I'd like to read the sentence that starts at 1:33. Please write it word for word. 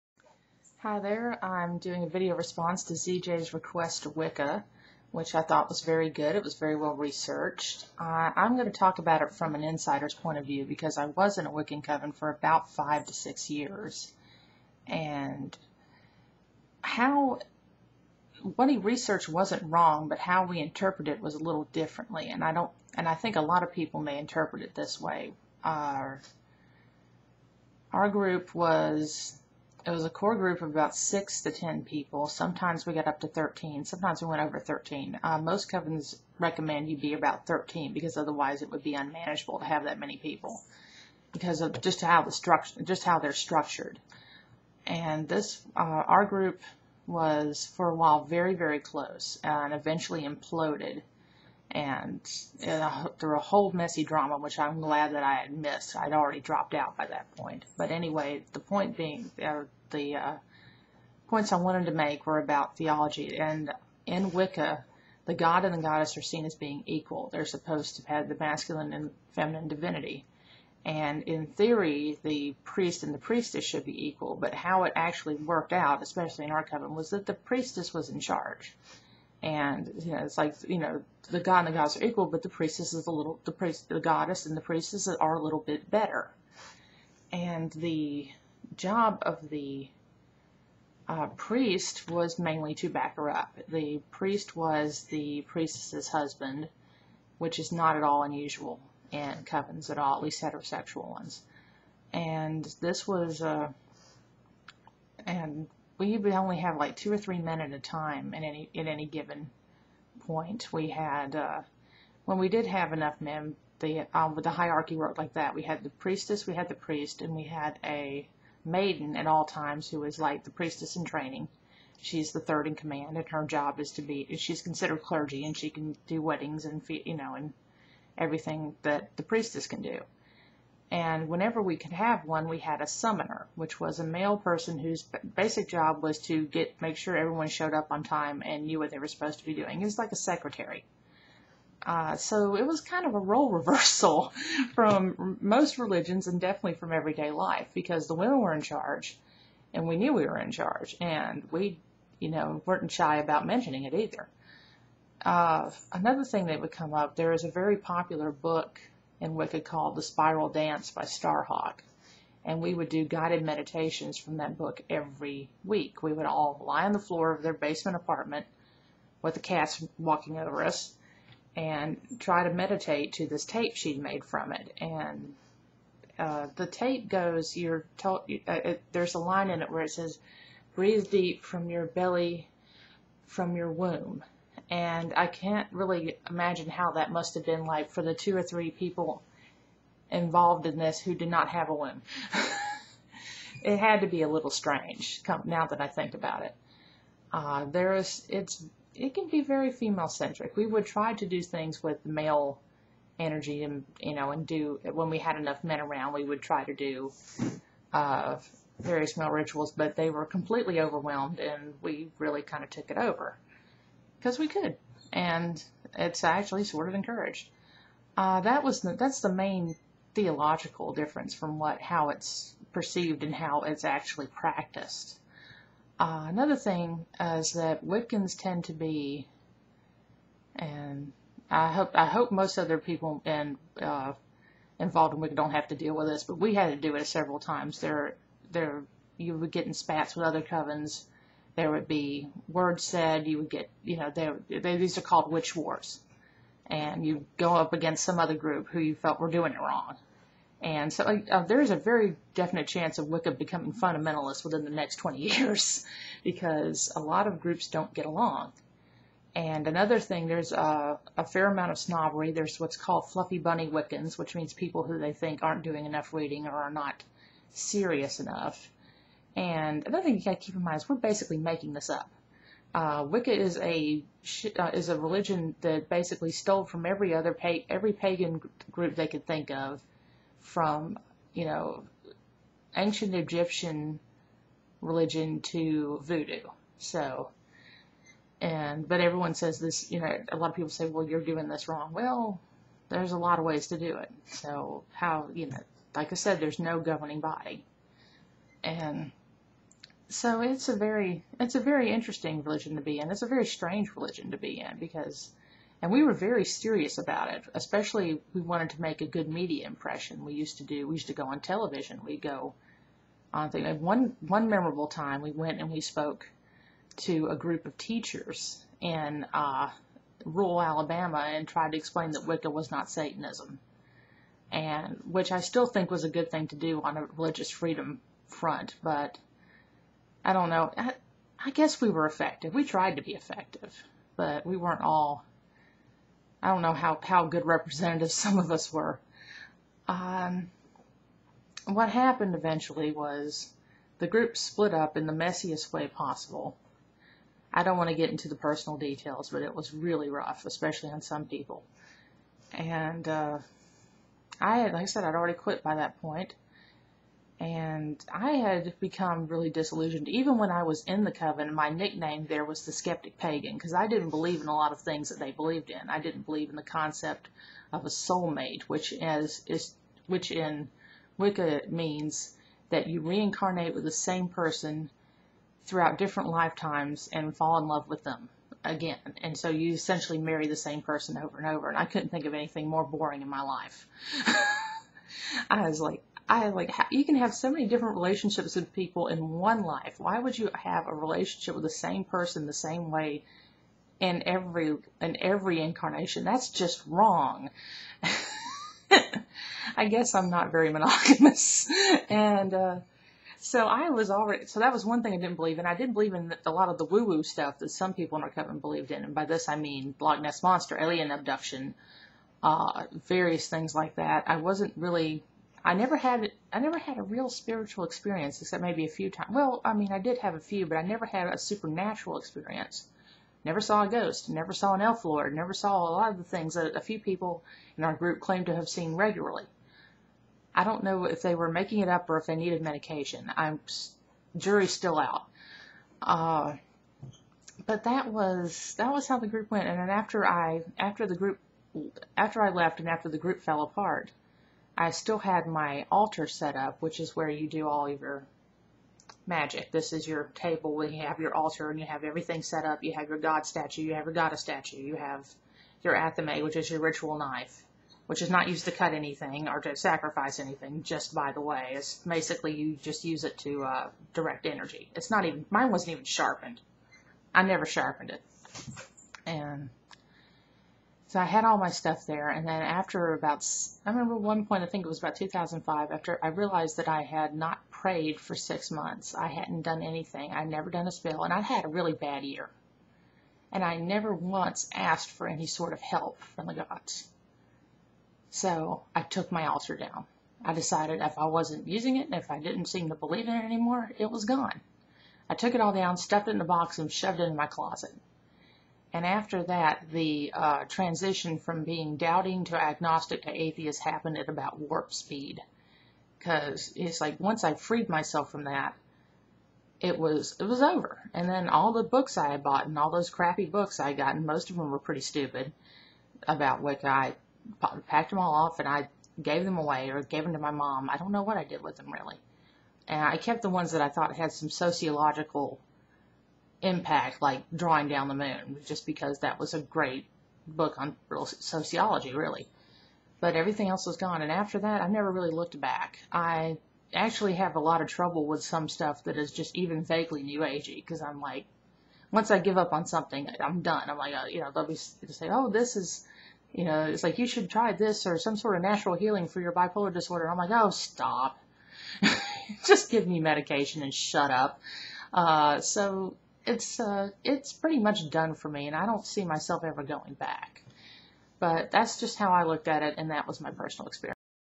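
The priest was the priestess's husband, which is not at all unusual in covens at all, at least heterosexual ones.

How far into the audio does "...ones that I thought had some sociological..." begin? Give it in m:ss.
8:43.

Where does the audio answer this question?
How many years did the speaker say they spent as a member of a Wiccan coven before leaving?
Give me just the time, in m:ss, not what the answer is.
0:12.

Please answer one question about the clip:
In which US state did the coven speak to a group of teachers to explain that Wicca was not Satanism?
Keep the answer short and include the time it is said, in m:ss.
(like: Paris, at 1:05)
Alabama, at 5:20.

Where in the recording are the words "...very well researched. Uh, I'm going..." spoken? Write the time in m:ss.
0:06.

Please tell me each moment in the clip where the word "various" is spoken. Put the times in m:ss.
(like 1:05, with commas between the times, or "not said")
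3:28, 6:53.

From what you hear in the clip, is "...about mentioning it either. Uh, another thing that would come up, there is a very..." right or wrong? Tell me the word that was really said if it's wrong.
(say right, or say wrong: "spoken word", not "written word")
right.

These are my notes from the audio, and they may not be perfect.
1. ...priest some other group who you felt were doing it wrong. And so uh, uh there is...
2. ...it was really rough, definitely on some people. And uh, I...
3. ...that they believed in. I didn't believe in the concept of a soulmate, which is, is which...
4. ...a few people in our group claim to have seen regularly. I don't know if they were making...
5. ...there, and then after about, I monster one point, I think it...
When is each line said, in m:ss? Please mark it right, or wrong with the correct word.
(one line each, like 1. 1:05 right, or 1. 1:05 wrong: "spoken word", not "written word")
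1. 4:07 wrong: "against", not "priest"
2. 5:49 wrong: "especially", not "definitely"
3. 6:05 right
4. 7:06 right
5. 7:52 wrong: "remember", not "monster".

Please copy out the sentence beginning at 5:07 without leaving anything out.
Especially we wanted to make a good media impression.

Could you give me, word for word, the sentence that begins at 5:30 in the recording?
I, I guess we were effective.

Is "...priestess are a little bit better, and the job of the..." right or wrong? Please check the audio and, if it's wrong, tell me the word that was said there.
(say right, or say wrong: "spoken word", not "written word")
right.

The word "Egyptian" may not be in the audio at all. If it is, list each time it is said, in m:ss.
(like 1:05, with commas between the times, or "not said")
4:43.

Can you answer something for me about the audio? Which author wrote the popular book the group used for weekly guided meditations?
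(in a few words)
Starhawk.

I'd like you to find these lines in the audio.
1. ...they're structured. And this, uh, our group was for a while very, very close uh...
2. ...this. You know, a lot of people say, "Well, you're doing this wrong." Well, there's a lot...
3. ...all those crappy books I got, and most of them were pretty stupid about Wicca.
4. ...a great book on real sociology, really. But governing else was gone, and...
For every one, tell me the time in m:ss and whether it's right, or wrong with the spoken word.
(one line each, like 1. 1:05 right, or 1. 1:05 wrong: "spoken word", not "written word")
1. 0:43 right
2. 4:49 right
3. 8:32 right
4. 8:49 wrong: "everything", not "governing".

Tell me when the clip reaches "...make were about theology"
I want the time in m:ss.
1:01.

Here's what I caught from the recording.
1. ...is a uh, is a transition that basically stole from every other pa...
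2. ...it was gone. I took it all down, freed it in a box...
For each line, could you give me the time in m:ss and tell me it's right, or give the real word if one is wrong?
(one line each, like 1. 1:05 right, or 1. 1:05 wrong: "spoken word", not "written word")
1. 4:33 wrong: "religion", not "transition"
2. 8:13 wrong: "stuffed", not "freed".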